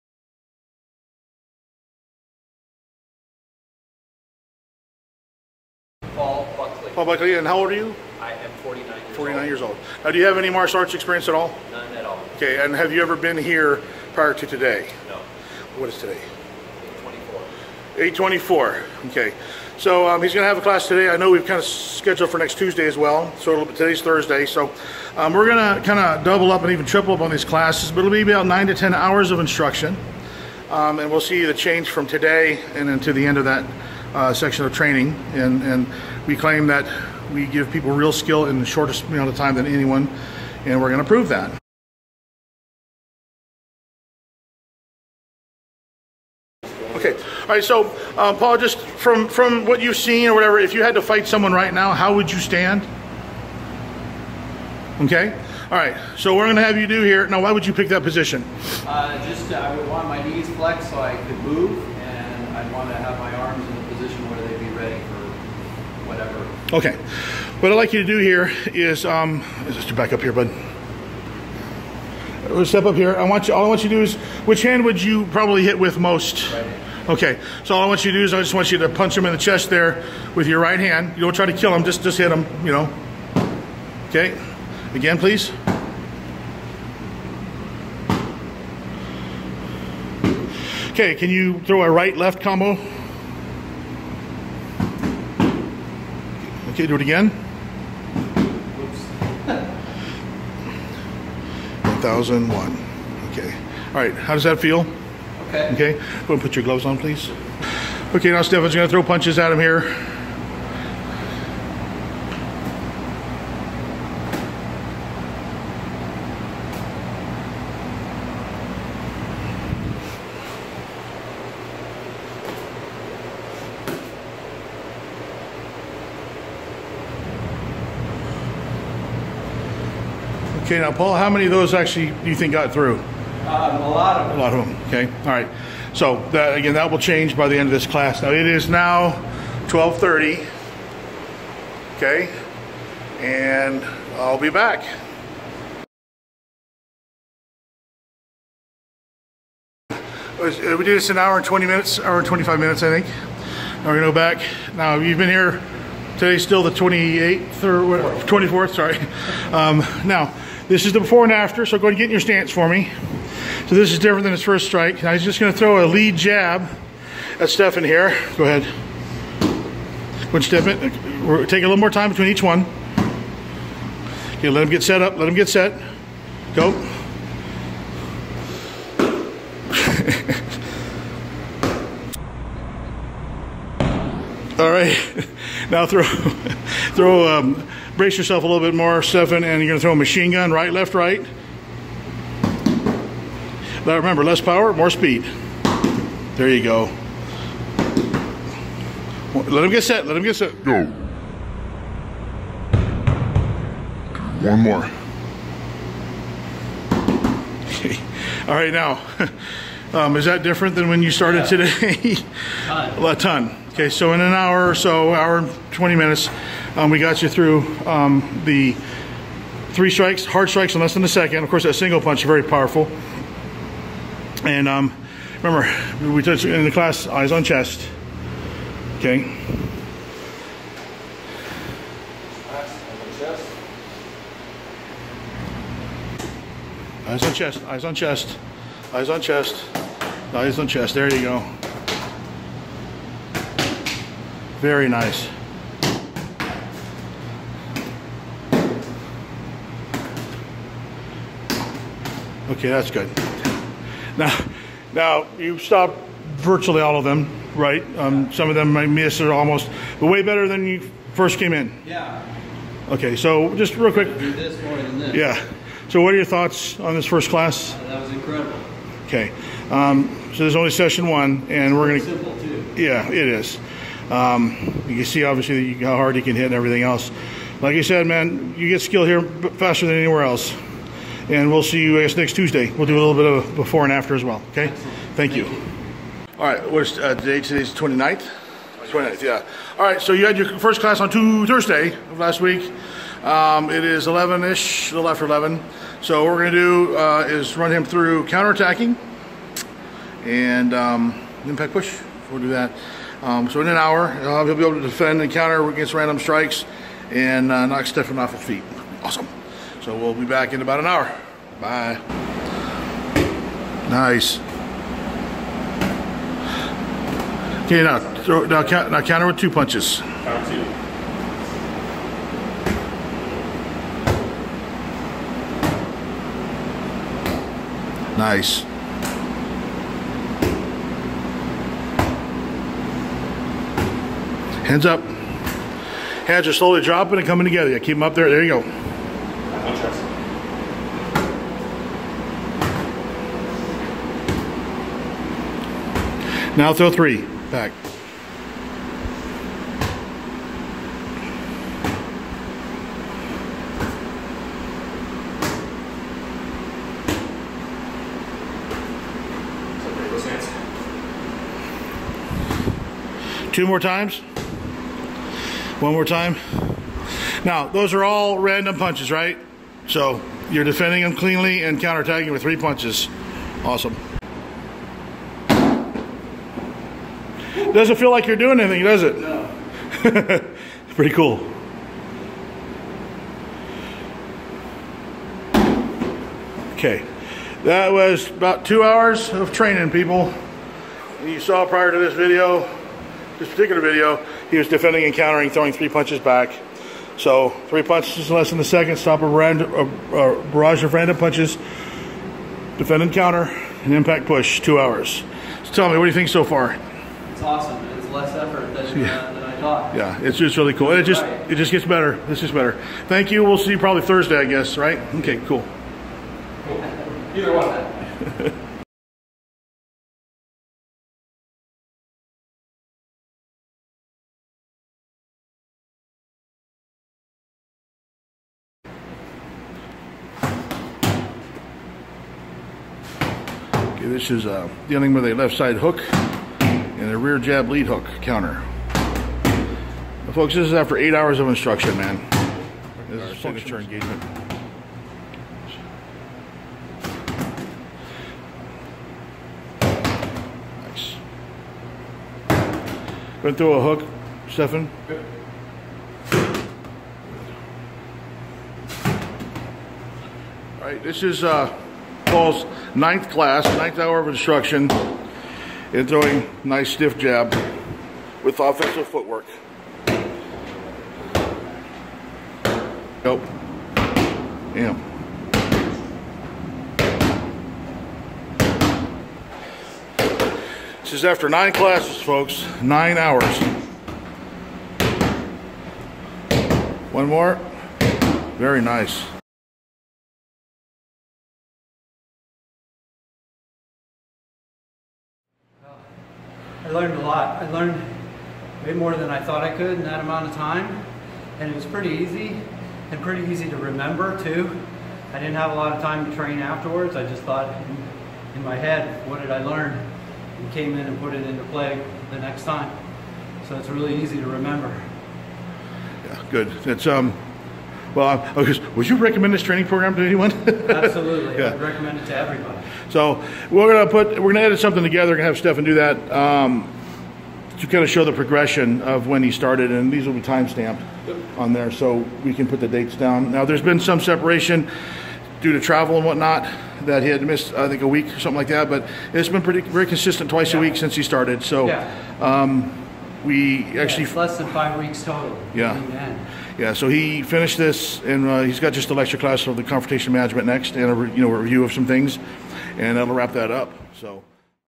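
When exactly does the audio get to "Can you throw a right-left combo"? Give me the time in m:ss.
1:31.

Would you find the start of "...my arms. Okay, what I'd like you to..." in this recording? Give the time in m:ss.
1:03.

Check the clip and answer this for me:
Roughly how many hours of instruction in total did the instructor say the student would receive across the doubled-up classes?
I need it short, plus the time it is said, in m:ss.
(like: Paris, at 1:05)
9 to 10 hours, at 0:28.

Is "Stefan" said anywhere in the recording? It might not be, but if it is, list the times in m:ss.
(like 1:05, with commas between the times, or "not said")
1:48, 2:47, 3:09, 5:07, 7:34, 8:45.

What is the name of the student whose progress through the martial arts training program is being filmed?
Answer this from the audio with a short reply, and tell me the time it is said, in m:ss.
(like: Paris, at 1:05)
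Paul Buckley, at 0:06.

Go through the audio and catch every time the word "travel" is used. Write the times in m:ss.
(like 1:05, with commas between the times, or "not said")
8:55.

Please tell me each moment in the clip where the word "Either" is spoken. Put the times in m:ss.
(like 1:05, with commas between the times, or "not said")
6:57.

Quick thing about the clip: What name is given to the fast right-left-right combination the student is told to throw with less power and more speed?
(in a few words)
Machine gun.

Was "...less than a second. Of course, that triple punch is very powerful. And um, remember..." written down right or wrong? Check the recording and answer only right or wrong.
wrong.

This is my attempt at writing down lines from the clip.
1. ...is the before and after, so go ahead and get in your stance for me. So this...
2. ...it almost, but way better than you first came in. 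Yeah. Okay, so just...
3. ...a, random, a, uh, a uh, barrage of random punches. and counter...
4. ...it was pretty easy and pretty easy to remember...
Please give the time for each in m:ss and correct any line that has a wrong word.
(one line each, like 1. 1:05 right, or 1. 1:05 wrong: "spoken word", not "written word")
1. 2:40 right
2. 4:19 right
3. 6:39 right
4. 8:21 right.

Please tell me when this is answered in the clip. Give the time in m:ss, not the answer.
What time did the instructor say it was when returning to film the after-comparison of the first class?
2:19.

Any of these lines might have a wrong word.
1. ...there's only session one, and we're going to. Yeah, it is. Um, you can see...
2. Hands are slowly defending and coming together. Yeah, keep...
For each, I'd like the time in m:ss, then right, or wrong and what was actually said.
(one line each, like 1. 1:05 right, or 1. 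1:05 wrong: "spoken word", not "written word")
1. 4:30 right
2. 5:36 wrong: "dropping", not "defending".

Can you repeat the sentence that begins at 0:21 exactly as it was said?
I know we've kind of scheduled for next Tuesday as well.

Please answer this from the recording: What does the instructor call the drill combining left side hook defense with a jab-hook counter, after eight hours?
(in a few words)
Signature engagement.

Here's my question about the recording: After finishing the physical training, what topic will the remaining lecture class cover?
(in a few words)
Confrontation management.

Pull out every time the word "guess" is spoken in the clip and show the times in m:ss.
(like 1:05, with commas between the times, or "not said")
4:42, 6:54.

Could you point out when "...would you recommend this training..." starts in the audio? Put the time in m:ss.
8:38.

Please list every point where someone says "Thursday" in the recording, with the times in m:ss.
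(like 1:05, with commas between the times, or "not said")
0:24, 4:51, 6:54.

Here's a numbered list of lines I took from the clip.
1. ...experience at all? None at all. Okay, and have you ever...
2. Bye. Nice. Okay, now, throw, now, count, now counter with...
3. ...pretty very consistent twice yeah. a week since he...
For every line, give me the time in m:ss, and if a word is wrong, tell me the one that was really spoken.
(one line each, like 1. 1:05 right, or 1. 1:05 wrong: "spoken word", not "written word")
1. 0:10 right
2. 5:11 right
3. 8:59 right.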